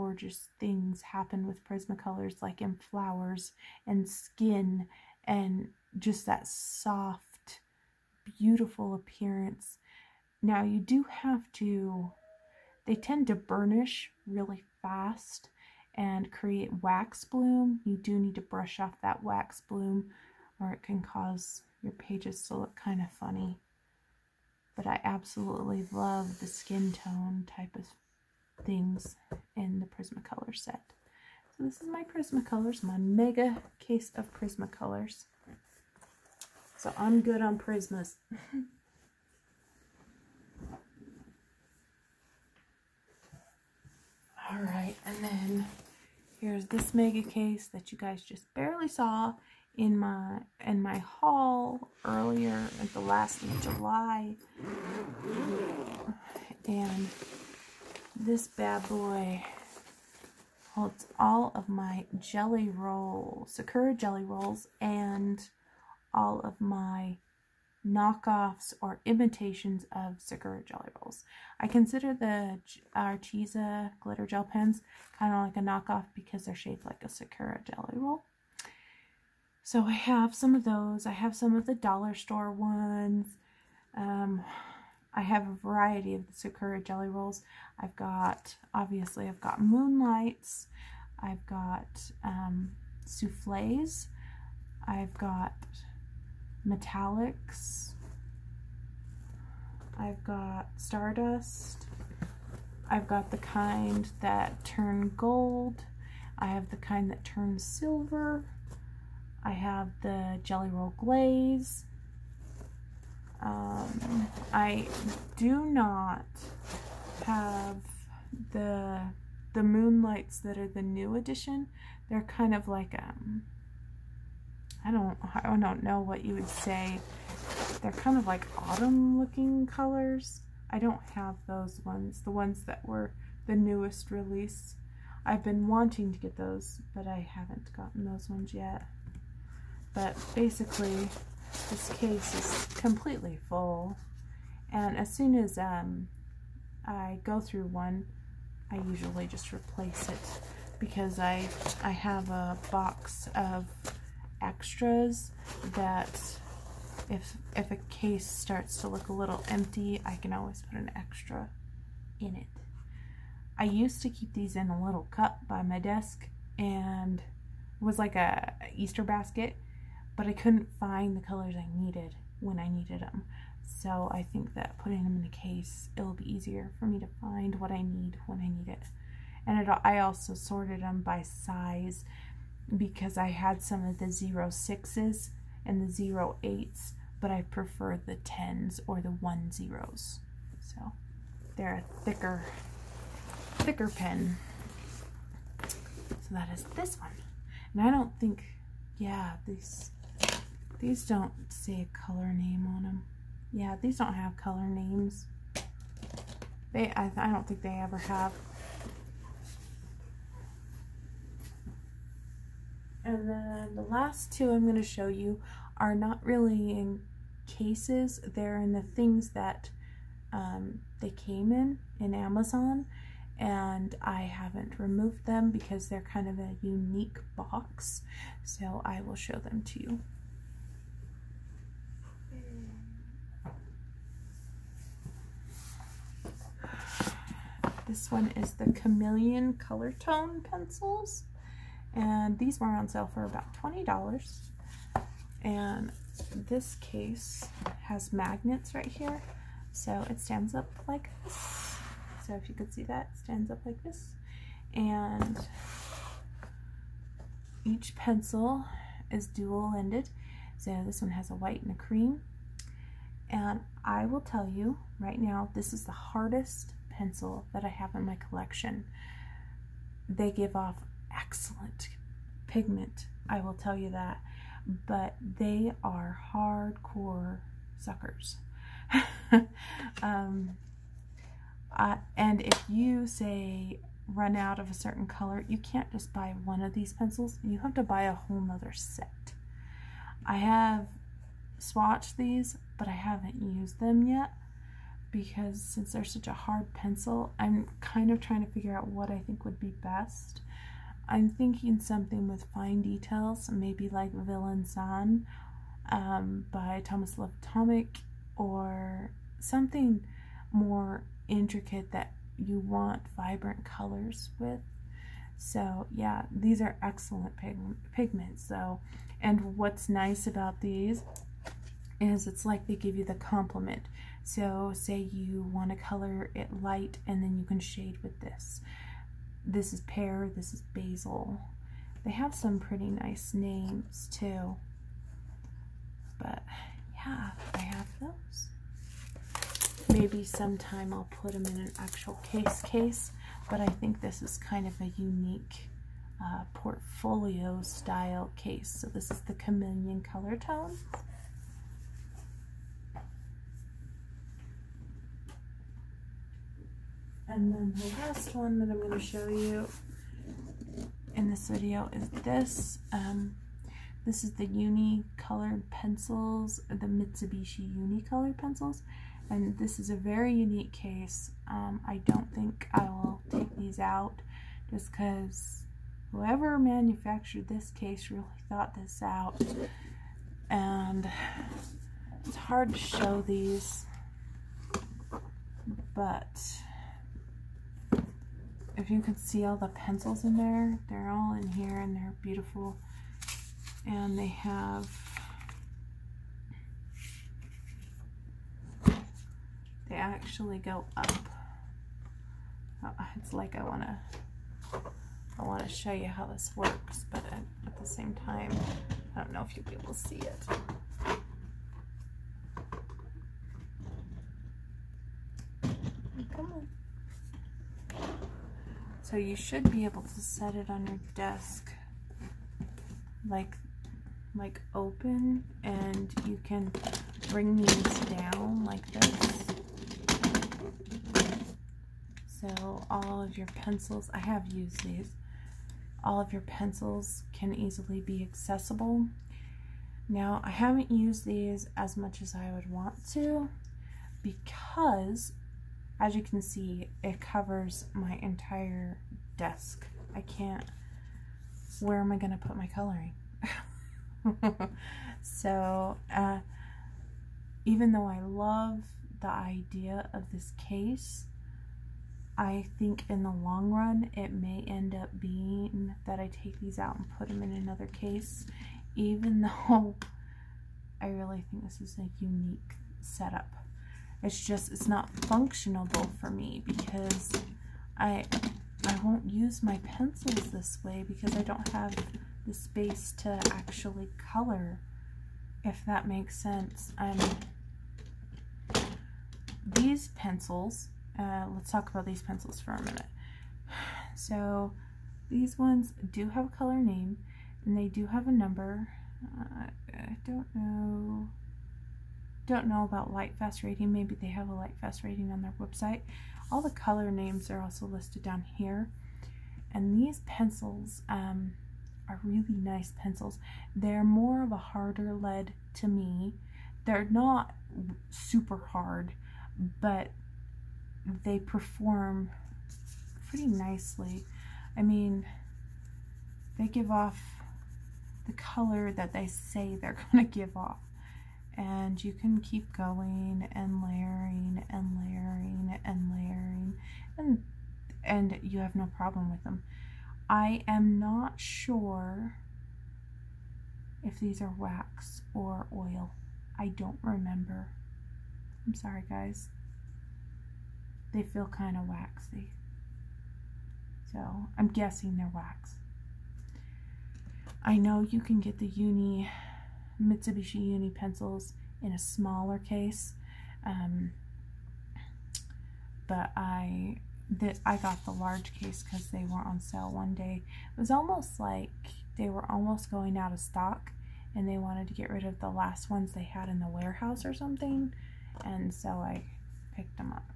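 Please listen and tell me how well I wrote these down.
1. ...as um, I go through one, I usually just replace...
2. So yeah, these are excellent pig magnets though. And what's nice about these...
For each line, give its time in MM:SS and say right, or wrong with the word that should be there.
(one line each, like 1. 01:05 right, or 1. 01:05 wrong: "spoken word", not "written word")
1. 02:25 right
2. 05:15 wrong: "pigments", not "magnets".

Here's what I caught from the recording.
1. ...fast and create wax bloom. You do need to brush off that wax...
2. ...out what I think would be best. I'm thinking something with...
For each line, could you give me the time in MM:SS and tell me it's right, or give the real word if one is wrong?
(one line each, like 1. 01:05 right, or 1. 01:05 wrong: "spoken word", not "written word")
1. 00:14 right
2. 04:58 right.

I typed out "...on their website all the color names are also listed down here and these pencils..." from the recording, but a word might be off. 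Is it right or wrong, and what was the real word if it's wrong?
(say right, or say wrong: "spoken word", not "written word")
right.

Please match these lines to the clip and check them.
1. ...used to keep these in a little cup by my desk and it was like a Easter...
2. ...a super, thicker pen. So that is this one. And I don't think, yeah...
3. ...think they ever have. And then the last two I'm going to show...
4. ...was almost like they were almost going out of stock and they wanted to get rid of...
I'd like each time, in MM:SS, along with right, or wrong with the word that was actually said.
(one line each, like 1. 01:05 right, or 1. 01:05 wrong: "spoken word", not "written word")
1. 02:43 right
2. 03:11 wrong: "thicker", not "super"
3. 03:27 right
4. 09:30 right.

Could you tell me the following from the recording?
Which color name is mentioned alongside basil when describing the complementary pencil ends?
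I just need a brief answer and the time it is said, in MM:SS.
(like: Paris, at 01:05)
Pear, at 05:29.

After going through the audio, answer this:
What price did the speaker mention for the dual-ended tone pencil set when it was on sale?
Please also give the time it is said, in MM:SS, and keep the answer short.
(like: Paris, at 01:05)
$20, at 04:03.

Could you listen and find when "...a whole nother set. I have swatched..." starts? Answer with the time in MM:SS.
04:48.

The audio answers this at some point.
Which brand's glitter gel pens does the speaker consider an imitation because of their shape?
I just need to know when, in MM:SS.
01:12.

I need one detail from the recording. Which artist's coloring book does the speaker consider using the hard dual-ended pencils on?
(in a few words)
Thomas Love.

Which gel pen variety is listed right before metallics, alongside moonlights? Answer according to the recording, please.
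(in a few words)
Souffles.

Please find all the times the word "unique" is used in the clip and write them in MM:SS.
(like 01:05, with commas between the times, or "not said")
03:46, 05:44, 06:10, 07:52.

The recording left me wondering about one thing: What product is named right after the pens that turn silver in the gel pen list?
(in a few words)
Jelly Roll Glaze.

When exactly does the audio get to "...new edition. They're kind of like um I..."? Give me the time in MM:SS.
02:00.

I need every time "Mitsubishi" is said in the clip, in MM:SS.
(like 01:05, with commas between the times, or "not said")
06:06, 09:20.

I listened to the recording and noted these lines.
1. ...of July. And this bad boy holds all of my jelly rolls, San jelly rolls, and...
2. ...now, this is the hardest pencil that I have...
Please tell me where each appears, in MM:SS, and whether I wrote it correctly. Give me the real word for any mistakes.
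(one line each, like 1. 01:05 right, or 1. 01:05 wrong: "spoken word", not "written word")
1. 00:53 wrong: "Sakura", not "San"
2. 04:25 right.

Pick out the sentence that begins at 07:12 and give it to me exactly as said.
So all of your pencils, I have used these, all of your pencils can easily be accessible.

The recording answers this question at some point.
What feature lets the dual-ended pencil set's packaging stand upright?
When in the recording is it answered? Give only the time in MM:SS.
04:08.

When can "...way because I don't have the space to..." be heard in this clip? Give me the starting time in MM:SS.
08:00.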